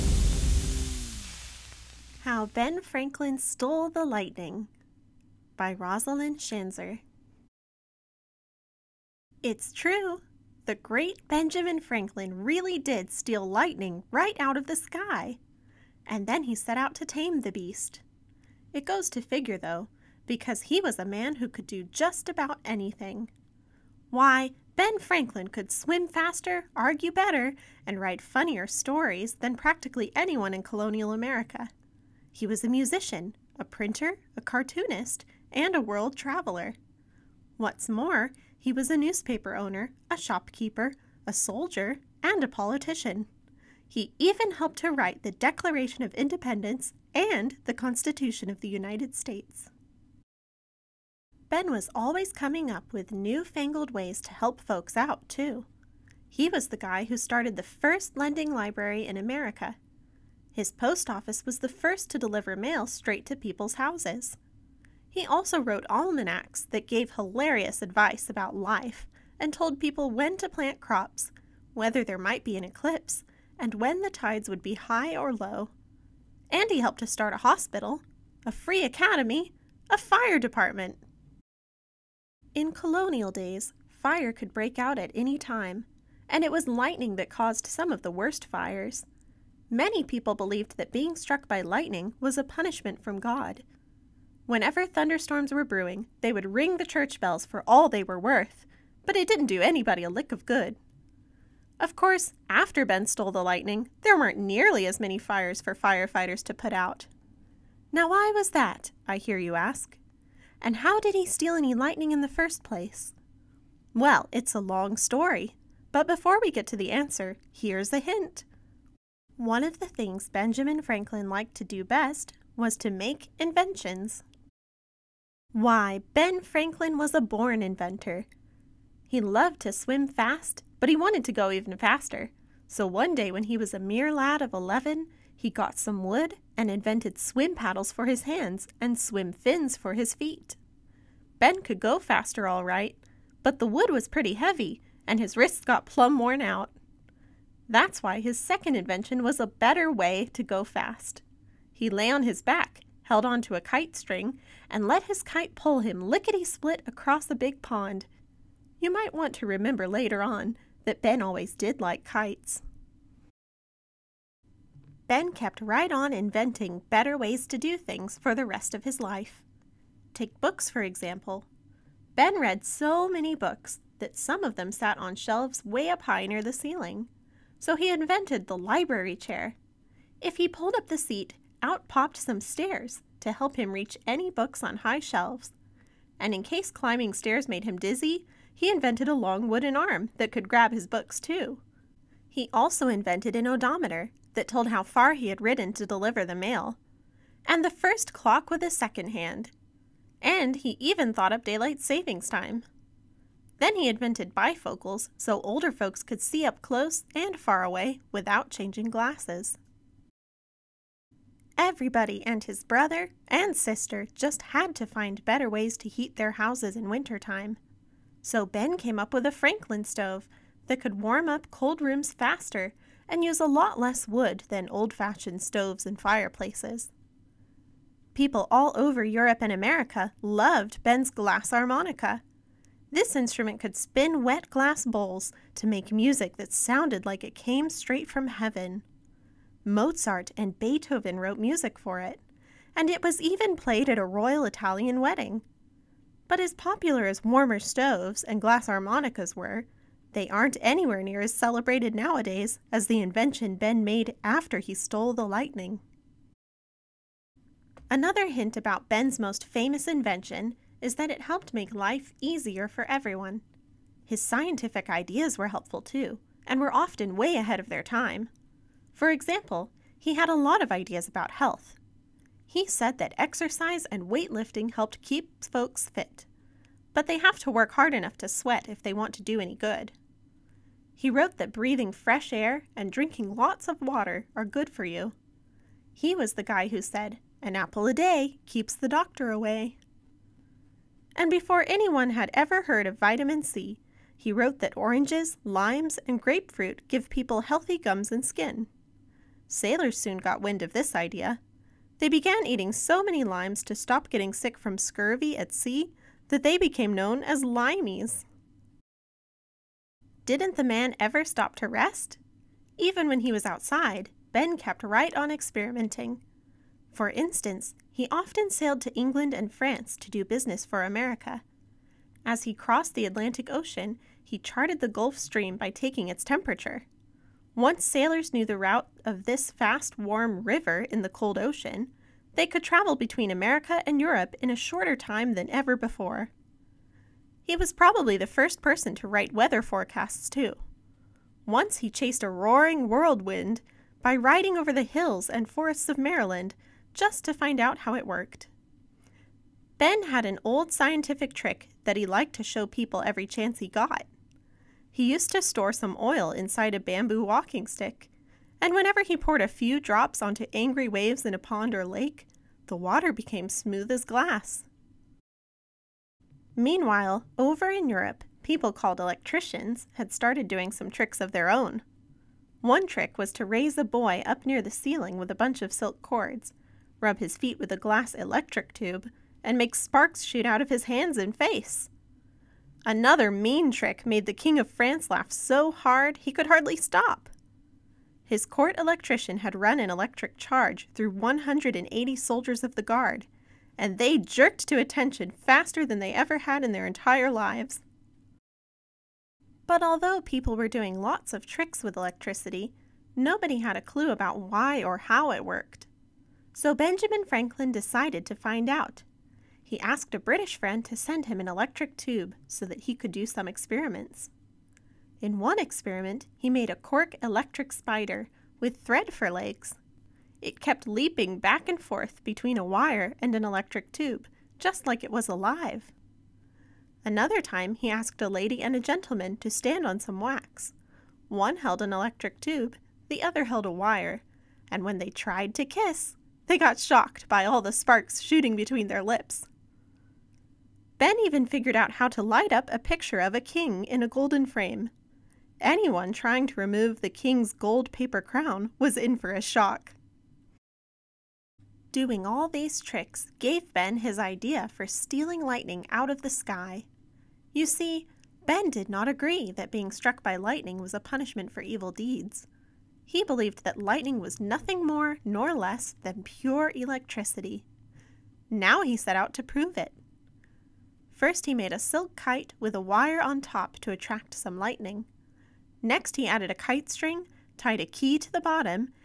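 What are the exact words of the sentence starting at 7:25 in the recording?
Anyone trying to remove the king's gold paper crown was in for a shock.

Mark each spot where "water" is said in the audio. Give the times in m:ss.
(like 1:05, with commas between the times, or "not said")
4:43, 6:02.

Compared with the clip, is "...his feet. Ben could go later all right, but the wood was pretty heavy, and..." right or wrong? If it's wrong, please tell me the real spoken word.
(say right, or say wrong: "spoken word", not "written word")
wrong: "faster", not "later".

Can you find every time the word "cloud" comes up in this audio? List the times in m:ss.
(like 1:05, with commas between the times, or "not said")
not said.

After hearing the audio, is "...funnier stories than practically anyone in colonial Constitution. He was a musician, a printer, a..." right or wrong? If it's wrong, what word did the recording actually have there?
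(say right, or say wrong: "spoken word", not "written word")
wrong: "America", not "Constitution".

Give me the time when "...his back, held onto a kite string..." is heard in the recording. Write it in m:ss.
2:32.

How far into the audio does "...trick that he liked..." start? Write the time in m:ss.
5:51.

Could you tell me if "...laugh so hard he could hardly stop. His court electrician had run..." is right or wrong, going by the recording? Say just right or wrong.
right.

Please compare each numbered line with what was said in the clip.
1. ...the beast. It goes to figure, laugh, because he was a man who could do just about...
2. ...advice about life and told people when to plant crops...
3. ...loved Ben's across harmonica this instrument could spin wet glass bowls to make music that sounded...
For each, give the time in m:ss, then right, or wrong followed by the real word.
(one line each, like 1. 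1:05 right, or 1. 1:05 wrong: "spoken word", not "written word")
1. 0:17 wrong: "though", not "laugh"
2. 1:07 right
3. 3:50 wrong: "glass", not "across".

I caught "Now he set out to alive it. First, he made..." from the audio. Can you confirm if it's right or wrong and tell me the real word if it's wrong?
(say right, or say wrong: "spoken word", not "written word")
wrong: "prove", not "alive".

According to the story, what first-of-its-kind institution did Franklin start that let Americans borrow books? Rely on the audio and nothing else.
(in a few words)
lending library.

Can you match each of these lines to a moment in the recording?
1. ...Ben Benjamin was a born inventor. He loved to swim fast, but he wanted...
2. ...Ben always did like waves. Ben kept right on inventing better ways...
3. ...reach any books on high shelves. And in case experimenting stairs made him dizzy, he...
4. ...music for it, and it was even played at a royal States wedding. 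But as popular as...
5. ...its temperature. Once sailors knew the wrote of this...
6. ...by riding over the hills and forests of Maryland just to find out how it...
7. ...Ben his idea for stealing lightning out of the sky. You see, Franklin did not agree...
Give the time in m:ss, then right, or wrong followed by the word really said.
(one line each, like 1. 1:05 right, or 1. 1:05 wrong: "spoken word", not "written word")
1. 2:06 wrong: "Franklin", not "Benjamin"
2. 2:41 wrong: "kites", not "waves"
3. 3:03 wrong: "climbing", not "experimenting"
4. 4:01 wrong: "Italian", not "States"
5. 5:26 wrong: "route", not "wrote"
6. 5:44 right
7. 7:33 wrong: "Ben", not "Franklin".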